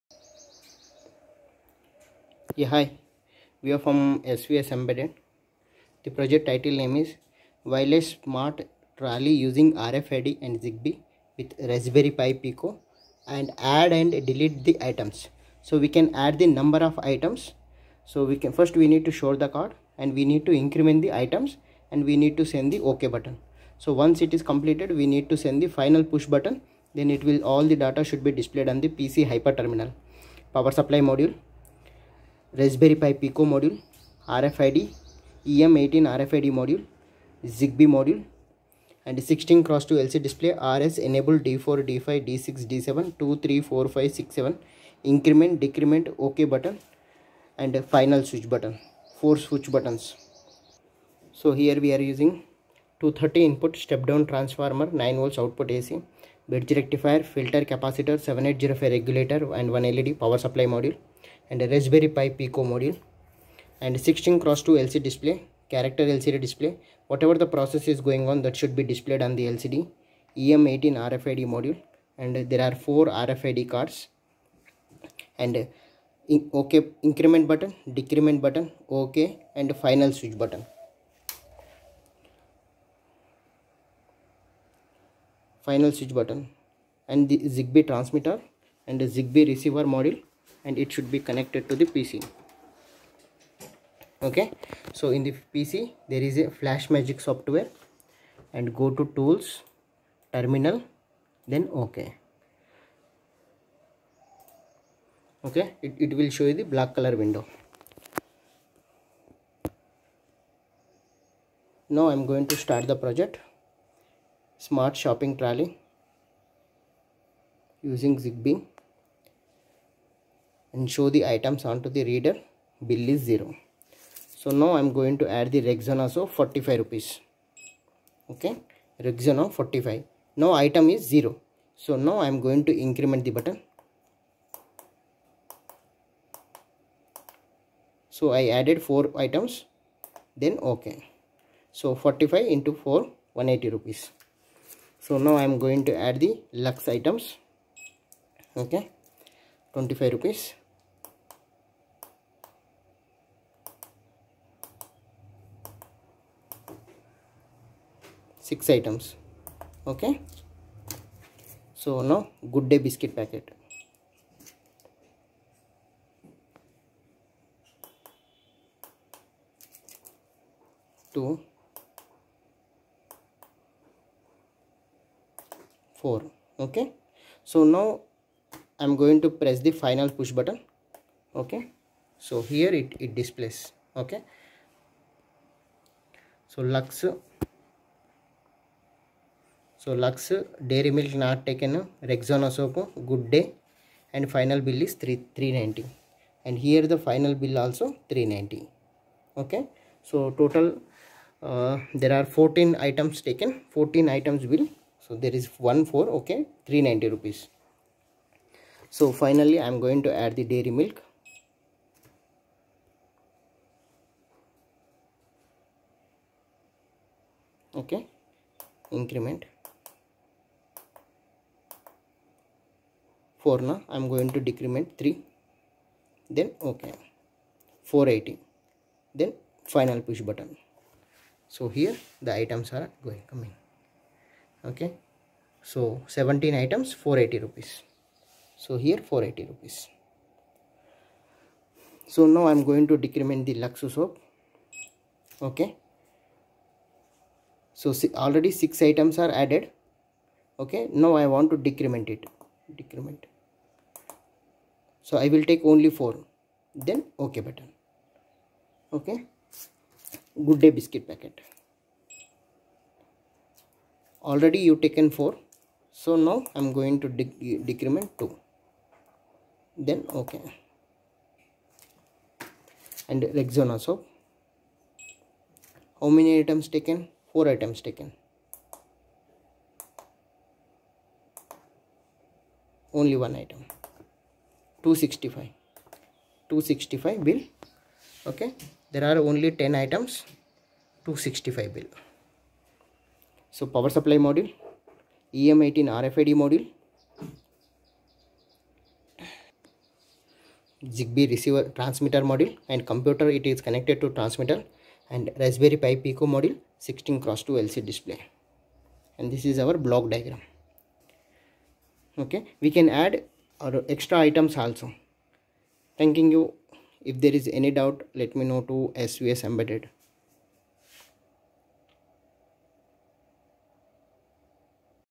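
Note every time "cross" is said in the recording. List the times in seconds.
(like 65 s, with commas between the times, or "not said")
39 s, 64 s, 307 s.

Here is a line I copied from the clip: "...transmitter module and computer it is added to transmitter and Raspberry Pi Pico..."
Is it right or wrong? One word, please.
wrong.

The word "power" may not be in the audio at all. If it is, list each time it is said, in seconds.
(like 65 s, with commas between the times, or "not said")
30 s, 60 s, 293 s.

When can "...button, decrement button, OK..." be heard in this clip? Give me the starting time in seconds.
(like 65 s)
77 s.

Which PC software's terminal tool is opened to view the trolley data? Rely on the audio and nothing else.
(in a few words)
Flash Magic.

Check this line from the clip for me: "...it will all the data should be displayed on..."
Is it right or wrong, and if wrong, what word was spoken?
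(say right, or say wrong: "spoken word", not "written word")
right.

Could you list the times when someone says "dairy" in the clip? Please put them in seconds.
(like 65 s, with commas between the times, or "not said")
190 s, 210 s.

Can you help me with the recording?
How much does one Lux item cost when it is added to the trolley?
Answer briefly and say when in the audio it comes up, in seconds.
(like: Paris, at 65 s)
25 rupees, at 149 s.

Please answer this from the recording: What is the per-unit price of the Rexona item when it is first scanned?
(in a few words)
45 rupees.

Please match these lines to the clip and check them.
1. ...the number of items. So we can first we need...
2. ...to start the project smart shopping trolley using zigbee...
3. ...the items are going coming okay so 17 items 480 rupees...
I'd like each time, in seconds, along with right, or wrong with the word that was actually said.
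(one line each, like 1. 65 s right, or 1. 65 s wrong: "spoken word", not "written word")
1. 16 s right
2. 112 s right
3. 232 s right.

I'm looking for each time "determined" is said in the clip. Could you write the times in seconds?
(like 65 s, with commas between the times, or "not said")
not said.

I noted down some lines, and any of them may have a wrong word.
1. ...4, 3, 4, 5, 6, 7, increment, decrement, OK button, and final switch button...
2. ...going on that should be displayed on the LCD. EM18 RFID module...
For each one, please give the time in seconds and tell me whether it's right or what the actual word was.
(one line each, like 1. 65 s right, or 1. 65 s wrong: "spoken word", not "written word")
1. 43 s wrong: "2", not "4"
2. 67 s right.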